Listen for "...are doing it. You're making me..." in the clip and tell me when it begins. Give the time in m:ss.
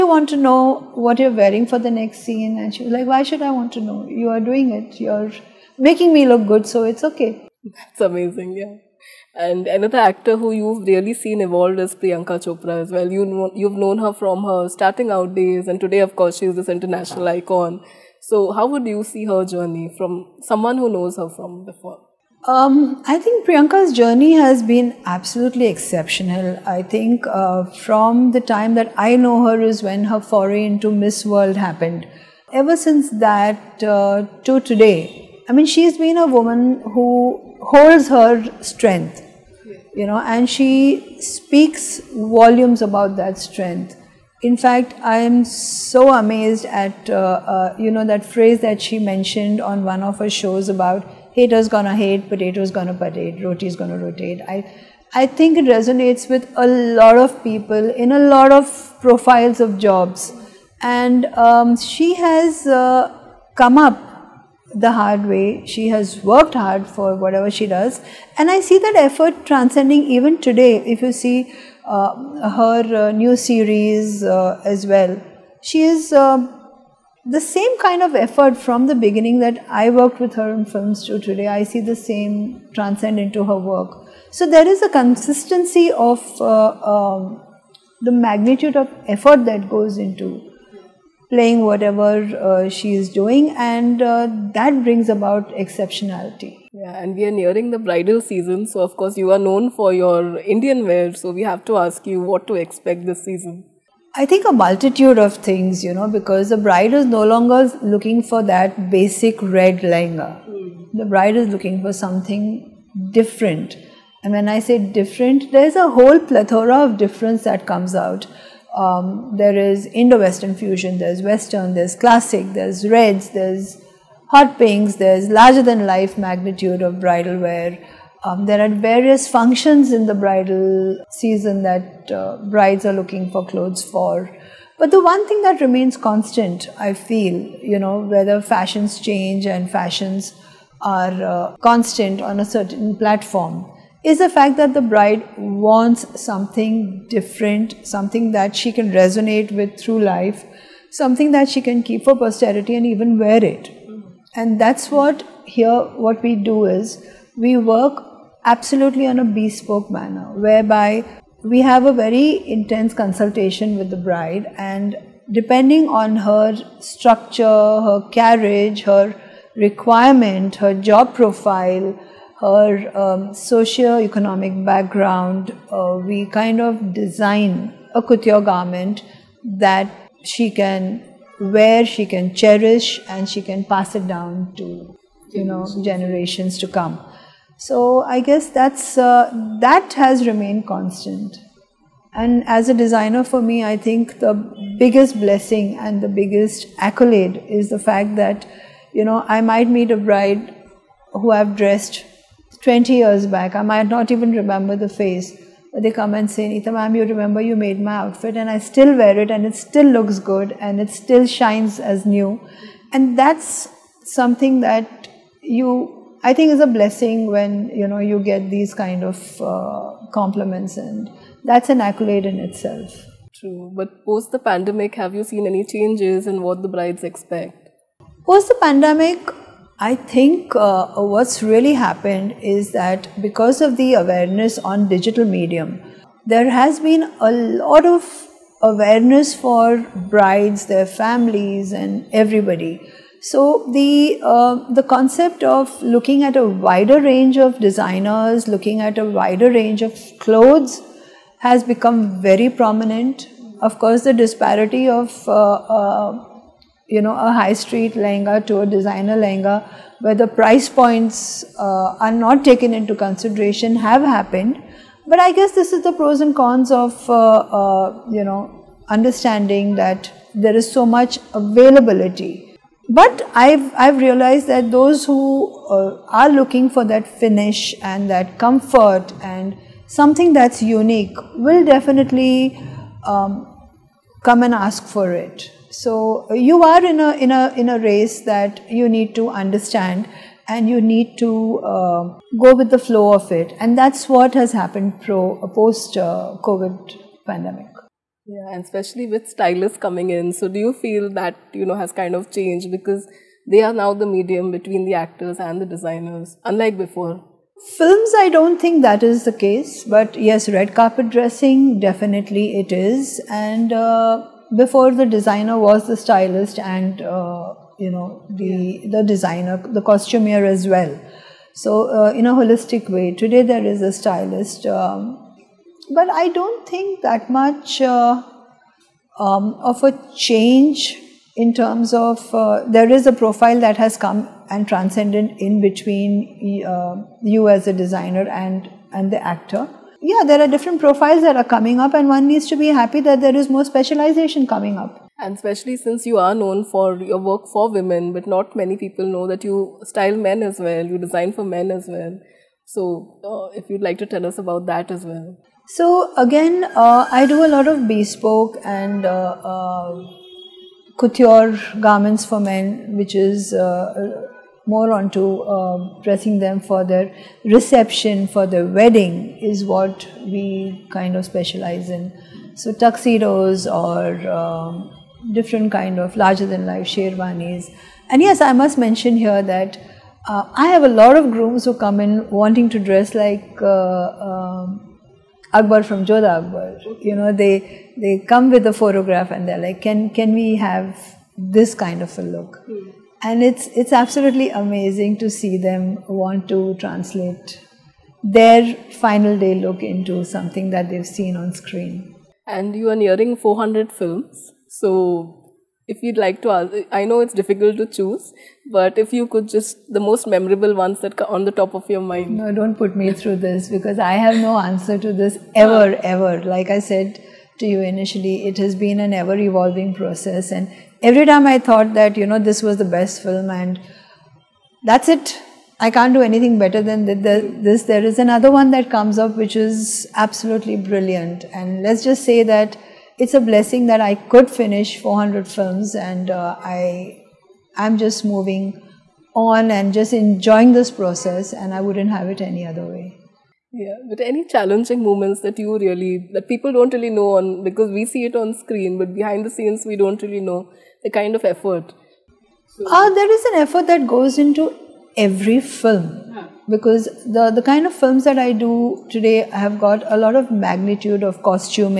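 0:04.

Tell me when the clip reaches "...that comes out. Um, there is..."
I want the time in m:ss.
1:57.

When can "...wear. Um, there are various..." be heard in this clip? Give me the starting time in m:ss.
2:07.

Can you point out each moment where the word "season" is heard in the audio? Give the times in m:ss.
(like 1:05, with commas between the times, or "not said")
1:38, 1:43, 2:11.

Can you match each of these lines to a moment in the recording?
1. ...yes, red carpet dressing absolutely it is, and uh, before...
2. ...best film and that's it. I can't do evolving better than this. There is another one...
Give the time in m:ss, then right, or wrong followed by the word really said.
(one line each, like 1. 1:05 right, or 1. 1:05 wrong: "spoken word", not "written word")
1. 5:10 wrong: "definitely", not "absolutely"
2. 7:02 wrong: "anything", not "evolving".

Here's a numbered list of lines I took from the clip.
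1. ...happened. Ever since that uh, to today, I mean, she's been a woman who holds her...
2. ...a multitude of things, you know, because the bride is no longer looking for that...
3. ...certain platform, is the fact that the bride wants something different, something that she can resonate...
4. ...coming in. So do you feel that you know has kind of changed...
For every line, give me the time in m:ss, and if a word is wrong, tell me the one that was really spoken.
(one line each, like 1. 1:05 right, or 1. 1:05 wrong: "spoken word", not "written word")
1. 0:31 right
2. 1:44 right
3. 2:22 right
4. 4:59 right.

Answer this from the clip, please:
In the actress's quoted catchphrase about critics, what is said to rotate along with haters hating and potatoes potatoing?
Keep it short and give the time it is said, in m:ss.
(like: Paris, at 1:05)
roti, at 0:53.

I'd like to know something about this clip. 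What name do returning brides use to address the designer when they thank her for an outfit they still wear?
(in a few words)
Neeta ma'am.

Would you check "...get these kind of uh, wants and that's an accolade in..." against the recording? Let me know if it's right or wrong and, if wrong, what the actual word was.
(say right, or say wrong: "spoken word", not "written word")
wrong: "compliments", not "wants".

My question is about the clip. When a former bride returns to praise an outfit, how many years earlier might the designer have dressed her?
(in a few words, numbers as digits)
20 years.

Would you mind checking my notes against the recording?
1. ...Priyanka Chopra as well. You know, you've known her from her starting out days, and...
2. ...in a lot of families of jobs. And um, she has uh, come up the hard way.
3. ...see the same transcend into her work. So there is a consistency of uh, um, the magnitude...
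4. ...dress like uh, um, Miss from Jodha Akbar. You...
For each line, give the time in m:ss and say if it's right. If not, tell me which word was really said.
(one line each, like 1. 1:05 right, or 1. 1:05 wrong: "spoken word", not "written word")
1. 0:11 right
2. 0:57 wrong: "profiles", not "families"
3. 1:21 right
4. 6:22 wrong: "Akbar", not "Miss".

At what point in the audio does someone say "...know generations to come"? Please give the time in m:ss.
3:05.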